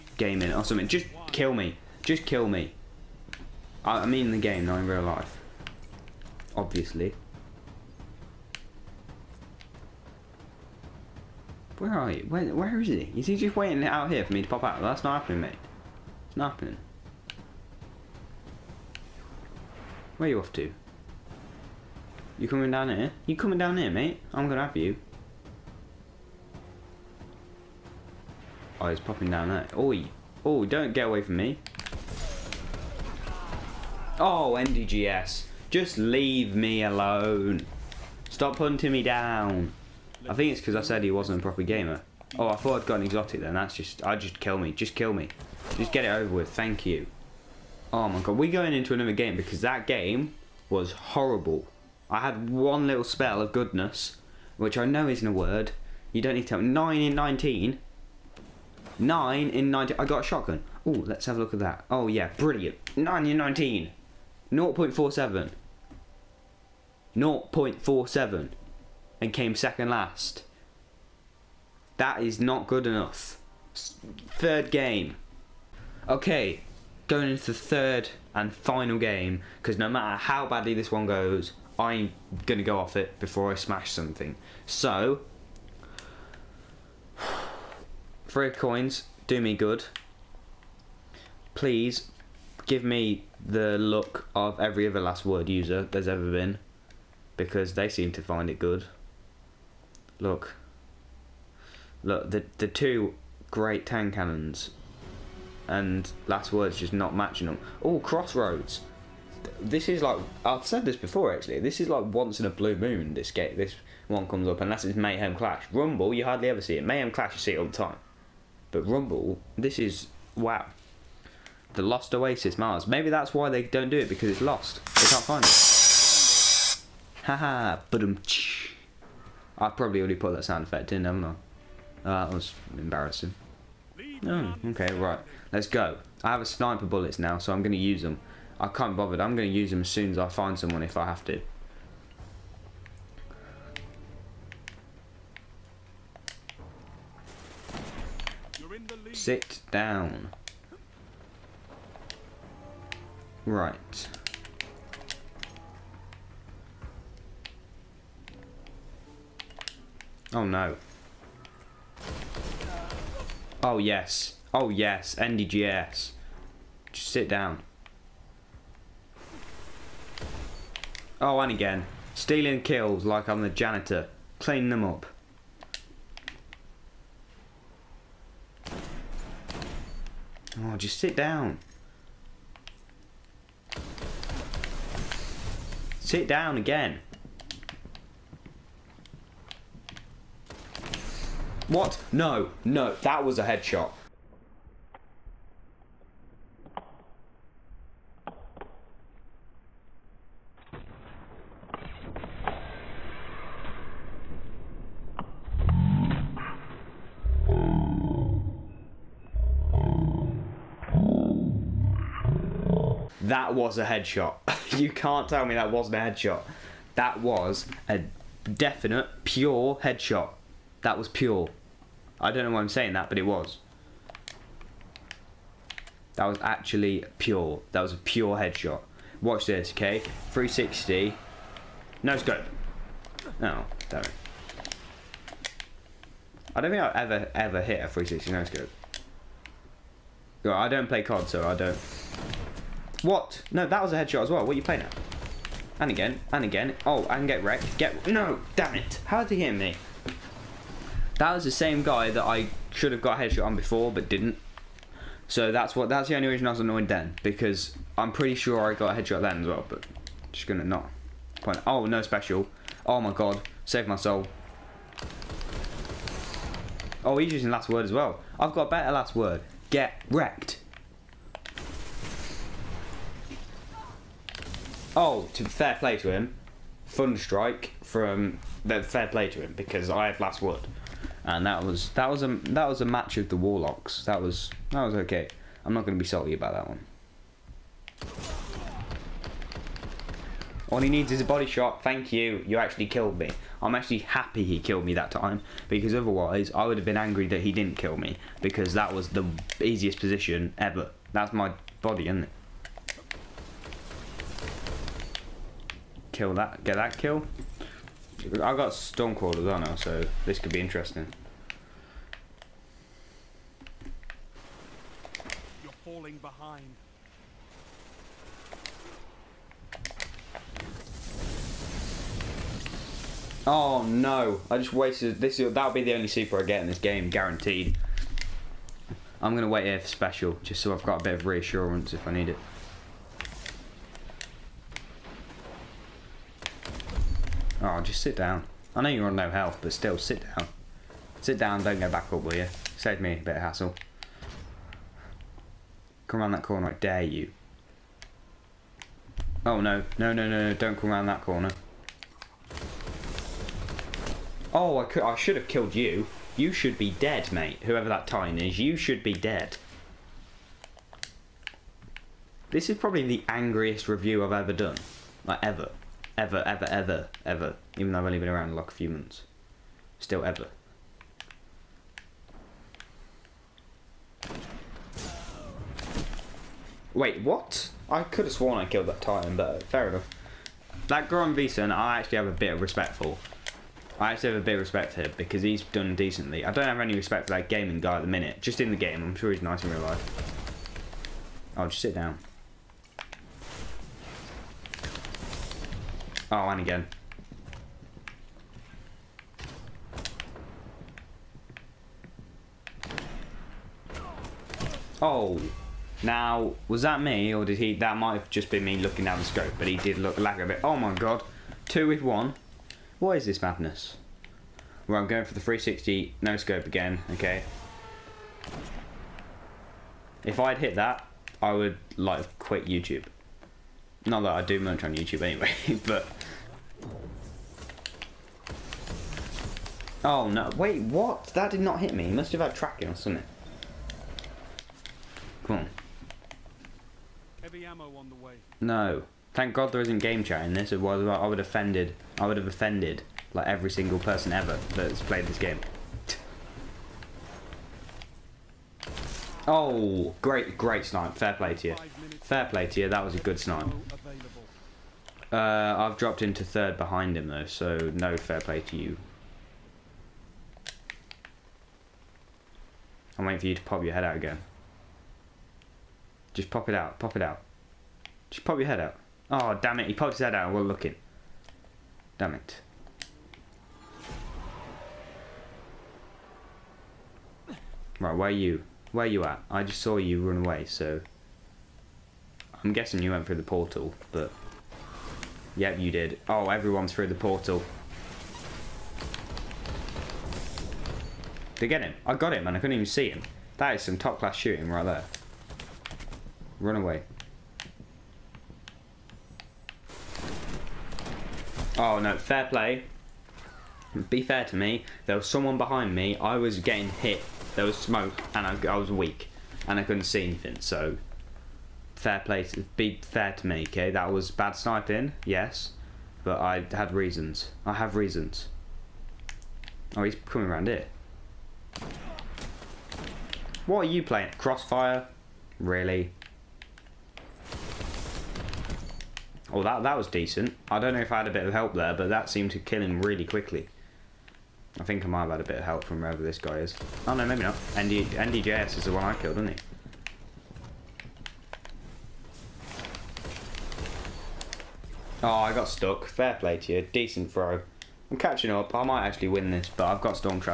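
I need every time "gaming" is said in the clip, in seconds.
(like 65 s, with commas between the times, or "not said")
0 s, 387 s.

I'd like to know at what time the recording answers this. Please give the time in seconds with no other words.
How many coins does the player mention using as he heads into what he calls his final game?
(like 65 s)
88 s.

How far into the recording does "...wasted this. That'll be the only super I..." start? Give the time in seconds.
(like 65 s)
324 s.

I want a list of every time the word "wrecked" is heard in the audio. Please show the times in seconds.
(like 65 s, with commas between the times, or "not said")
247 s, 270 s.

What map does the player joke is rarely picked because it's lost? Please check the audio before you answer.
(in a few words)
The Lost Oasis.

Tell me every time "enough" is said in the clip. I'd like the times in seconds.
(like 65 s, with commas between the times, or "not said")
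72 s, 379 s.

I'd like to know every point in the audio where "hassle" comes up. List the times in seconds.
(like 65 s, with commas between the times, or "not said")
343 s.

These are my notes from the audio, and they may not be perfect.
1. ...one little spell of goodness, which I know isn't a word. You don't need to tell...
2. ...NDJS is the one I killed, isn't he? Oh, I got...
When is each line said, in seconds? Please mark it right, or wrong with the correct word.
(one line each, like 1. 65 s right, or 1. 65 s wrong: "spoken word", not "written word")
1. 52 s right
2. 538 s right.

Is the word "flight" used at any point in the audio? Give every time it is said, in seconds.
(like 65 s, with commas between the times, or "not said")
not said.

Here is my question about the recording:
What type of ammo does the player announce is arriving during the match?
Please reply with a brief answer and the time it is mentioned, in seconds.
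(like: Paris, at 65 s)
Heavy ammo, at 437 s.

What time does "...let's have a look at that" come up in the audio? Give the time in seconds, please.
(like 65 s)
60 s.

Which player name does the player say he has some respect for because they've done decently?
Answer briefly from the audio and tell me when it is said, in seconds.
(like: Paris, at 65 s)
Goron Vison, at 381 s.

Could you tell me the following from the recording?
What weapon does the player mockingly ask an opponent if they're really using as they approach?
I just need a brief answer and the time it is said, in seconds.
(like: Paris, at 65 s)
Crossfire, at 524 s.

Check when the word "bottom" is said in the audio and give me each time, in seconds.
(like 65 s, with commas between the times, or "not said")
not said.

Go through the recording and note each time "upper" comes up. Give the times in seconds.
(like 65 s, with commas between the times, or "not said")
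not said.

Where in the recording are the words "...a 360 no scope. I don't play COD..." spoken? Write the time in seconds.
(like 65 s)
237 s.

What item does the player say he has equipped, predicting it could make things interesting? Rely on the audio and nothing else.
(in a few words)
Stone Quarters.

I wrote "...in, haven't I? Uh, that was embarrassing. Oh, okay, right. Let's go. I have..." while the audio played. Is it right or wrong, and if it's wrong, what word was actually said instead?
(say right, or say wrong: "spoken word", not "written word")
right.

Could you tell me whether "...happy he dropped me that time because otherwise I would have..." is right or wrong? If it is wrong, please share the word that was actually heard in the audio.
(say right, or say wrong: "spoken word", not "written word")
wrong: "killed", not "dropped".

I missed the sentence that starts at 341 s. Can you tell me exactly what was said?
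Sit down, don't go back up, will you?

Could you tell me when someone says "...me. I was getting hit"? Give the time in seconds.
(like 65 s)
505 s.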